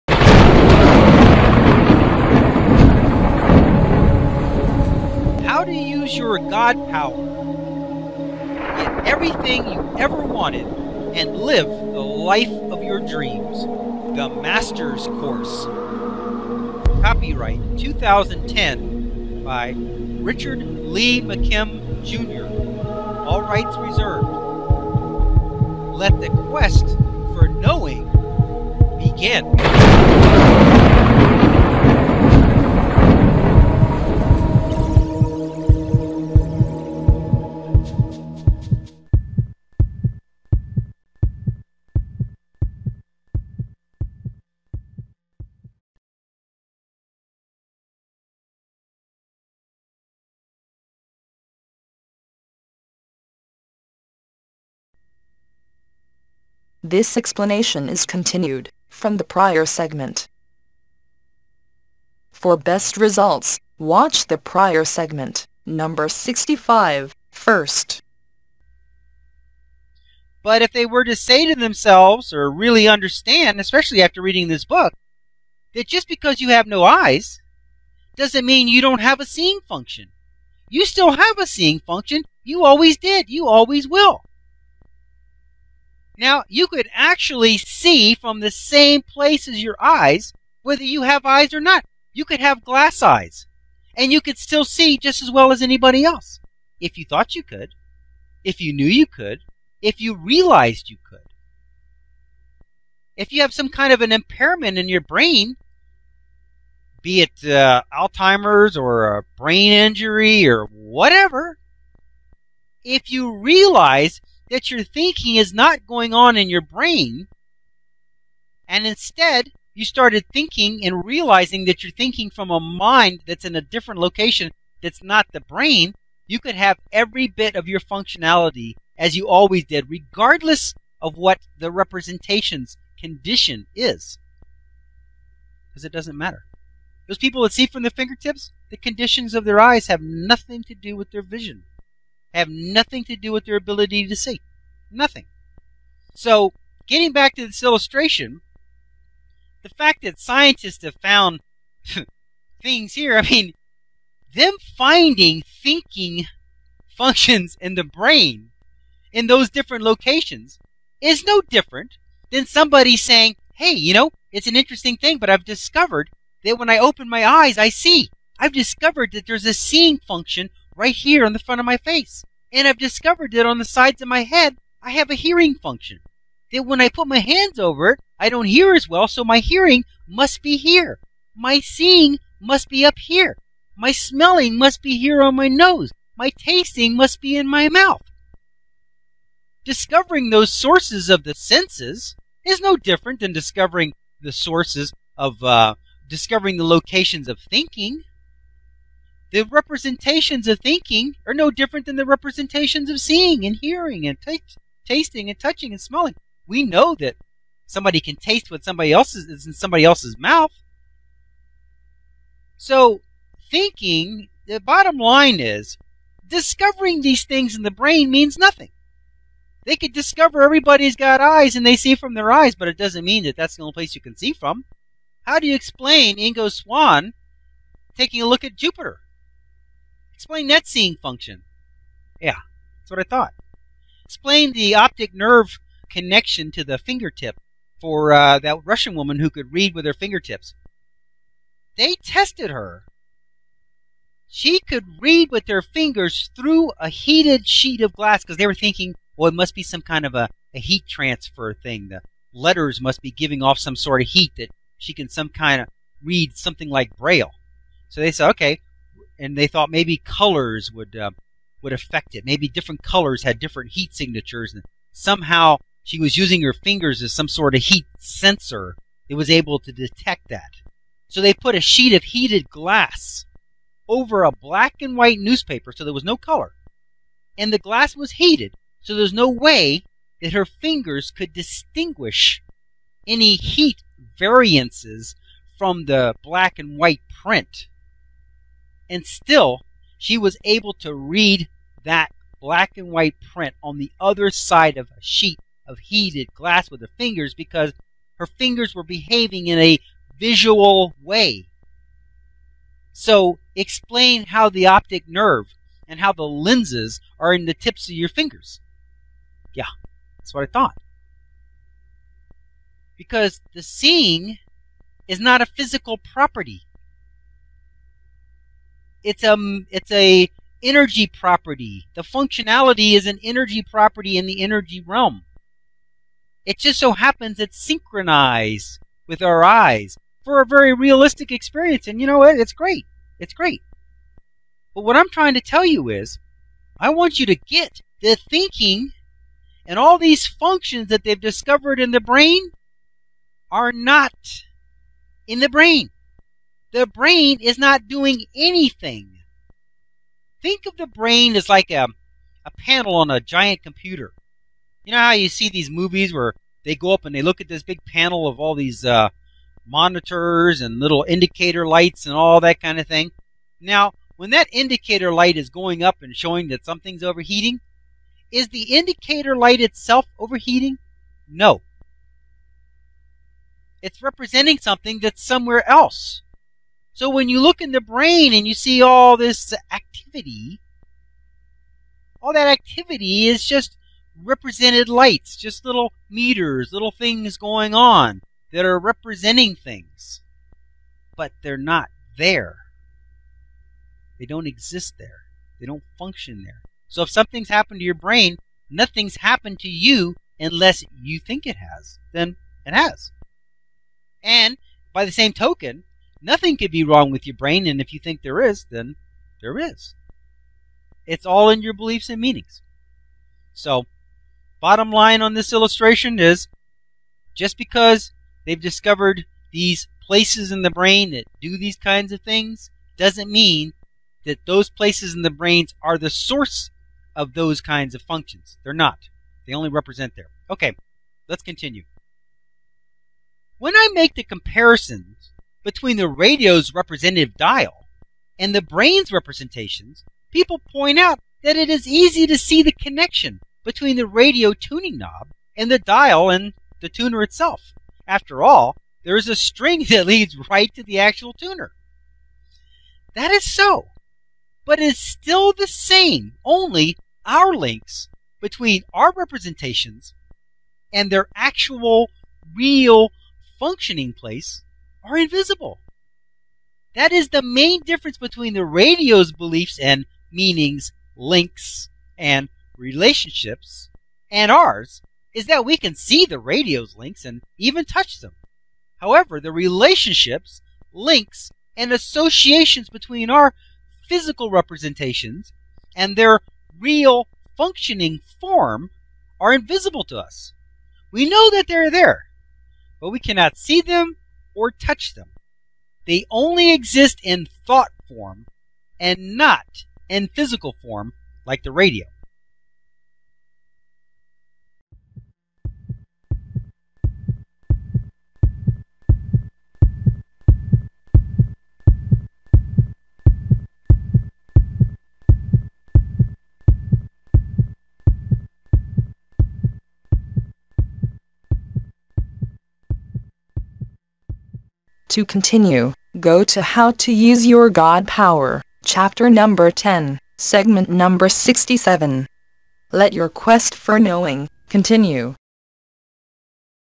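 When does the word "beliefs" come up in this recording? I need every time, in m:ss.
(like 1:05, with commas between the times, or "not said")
6:51, 7:49.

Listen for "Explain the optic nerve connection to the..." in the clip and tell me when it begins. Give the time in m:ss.
3:54.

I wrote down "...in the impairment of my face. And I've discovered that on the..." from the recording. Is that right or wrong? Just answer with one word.
wrong.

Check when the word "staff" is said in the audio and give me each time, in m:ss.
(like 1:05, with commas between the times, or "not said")
not said.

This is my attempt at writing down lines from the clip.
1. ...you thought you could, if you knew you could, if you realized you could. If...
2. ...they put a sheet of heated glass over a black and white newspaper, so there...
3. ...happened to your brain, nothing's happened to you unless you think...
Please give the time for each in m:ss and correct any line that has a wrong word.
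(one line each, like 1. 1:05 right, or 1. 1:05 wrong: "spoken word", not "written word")
1. 1:36 right
2. 4:31 right
3. 6:37 right.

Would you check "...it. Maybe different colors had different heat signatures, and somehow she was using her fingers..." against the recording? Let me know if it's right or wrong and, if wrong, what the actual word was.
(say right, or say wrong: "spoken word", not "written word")
right.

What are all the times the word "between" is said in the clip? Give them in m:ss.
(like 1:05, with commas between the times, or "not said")
7:15, 7:23, 7:38, 7:48, 8:02.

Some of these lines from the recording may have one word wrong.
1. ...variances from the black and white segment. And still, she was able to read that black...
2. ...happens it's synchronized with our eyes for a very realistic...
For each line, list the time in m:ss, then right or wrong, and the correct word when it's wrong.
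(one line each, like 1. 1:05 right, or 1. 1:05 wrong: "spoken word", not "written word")
1. 4:44 wrong: "print", not "segment"
2. 5:26 right.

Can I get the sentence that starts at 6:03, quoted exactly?
Now, when that indicator light is going up and showing that something's overheating, is the indicator light itself overheating?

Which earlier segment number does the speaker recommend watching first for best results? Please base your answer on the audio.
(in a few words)
65.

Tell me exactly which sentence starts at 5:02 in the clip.
So, explain how the optic nerve and how the lenses are in the tips of your fingers.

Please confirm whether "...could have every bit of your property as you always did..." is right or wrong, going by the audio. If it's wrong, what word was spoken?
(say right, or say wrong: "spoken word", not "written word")
wrong: "functionality", not "property".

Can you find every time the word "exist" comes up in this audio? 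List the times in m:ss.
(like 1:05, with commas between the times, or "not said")
6:34, 8:16.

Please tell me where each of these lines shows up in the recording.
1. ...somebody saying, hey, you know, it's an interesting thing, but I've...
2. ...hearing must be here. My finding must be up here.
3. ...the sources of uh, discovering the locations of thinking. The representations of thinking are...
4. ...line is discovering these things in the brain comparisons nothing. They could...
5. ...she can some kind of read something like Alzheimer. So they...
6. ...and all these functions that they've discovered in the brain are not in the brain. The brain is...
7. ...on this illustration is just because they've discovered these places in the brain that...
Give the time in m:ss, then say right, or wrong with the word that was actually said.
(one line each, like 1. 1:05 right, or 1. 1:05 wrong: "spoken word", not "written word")
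1. 2:42 right
2. 2:59 wrong: "seeing", not "finding"
3. 3:14 right
4. 3:34 wrong: "means", not "comparisons"
5. 4:14 wrong: "Braille", not "Alzheimer"
6. 5:39 right
7. 6:55 right.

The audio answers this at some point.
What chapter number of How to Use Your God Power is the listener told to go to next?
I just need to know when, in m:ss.
8:49.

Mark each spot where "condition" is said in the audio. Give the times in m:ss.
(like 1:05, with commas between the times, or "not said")
2:12, 2:18.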